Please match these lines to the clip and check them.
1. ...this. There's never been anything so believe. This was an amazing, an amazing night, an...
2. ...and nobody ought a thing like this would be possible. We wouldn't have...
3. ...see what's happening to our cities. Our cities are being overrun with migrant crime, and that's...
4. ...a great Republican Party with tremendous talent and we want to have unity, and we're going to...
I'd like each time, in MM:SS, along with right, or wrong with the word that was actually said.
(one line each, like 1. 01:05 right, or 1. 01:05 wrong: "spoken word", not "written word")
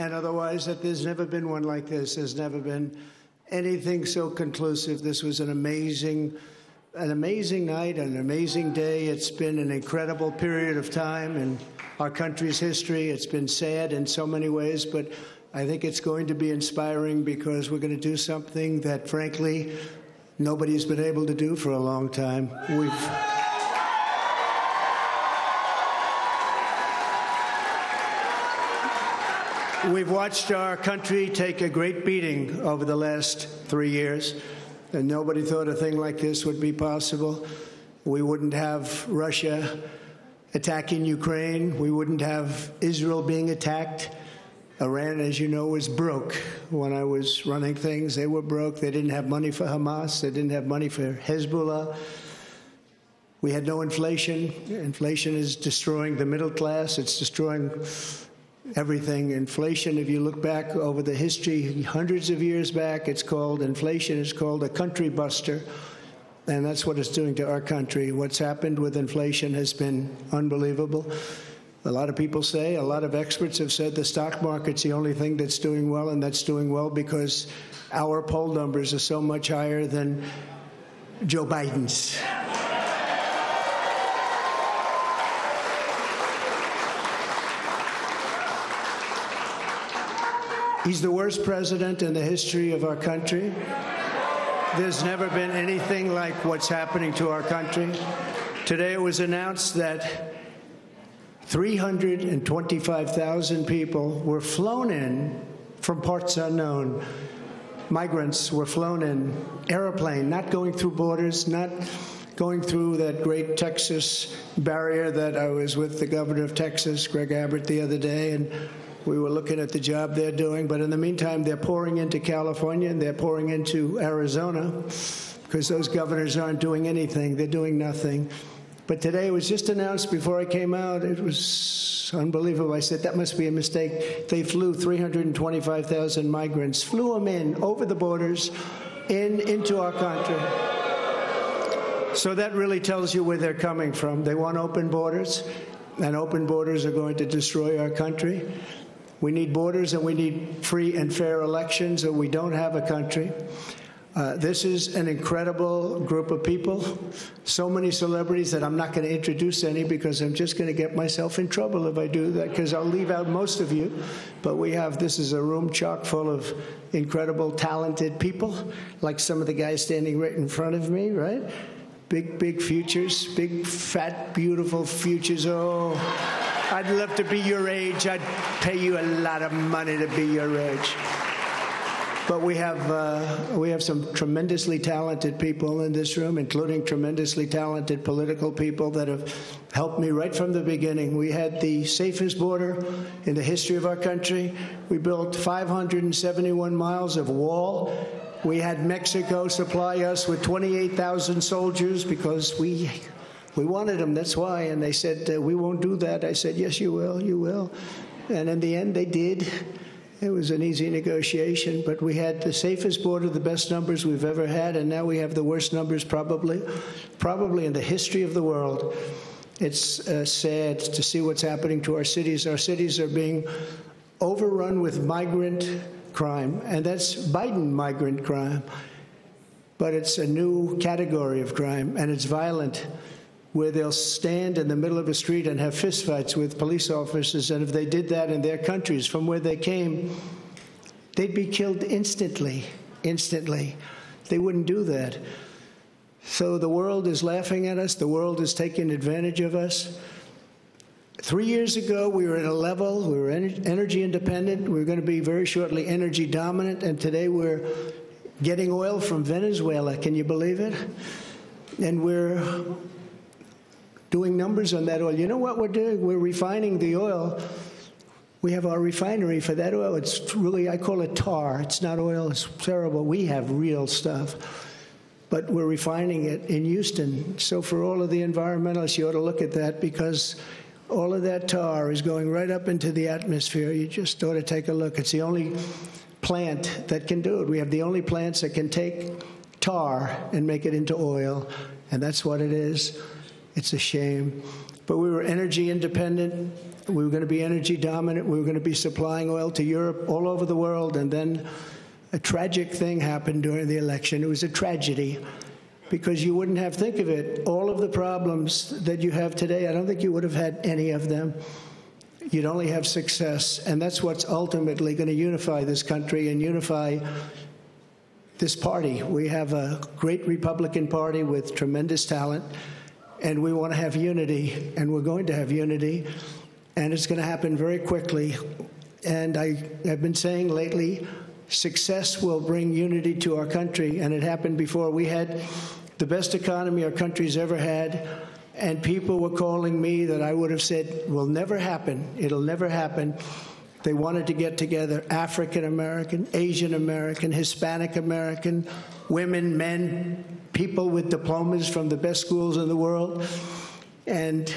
1. 00:01 wrong: "conclusive", not "believe"
2. 00:34 wrong: "thought", not "ought"
3. 03:41 right
4. 05:19 right.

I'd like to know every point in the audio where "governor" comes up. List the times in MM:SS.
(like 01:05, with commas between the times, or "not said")
01:56, 02:05.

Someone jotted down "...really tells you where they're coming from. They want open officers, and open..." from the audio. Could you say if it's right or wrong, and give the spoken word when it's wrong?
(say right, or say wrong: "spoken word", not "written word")
wrong: "borders", not "officers".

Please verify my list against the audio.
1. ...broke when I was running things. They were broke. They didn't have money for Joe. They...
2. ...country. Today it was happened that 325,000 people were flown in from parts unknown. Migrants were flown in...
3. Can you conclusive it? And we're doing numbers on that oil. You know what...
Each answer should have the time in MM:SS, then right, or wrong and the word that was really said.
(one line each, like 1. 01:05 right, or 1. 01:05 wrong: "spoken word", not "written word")
1. 00:45 wrong: "Hamas", not "Joe"
2. 01:37 wrong: "announced", not "happened"
3. 04:19 wrong: "believe", not "conclusive".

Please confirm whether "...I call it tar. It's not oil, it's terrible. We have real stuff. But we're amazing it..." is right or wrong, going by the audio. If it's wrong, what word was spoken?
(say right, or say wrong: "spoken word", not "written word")
wrong: "refining", not "amazing".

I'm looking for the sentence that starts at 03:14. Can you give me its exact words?
We built 571 miles of wall.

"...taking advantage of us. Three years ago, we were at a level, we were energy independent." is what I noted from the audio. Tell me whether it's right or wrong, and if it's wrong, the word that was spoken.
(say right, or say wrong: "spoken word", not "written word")
right.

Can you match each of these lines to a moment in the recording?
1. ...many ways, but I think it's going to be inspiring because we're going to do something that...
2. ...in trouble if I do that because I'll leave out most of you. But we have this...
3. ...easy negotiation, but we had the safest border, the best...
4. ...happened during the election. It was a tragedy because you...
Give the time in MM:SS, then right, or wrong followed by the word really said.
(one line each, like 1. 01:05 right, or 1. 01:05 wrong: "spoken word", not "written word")
1. 00:14 right
2. 02:41 right
3. 03:30 right
4. 05:02 right.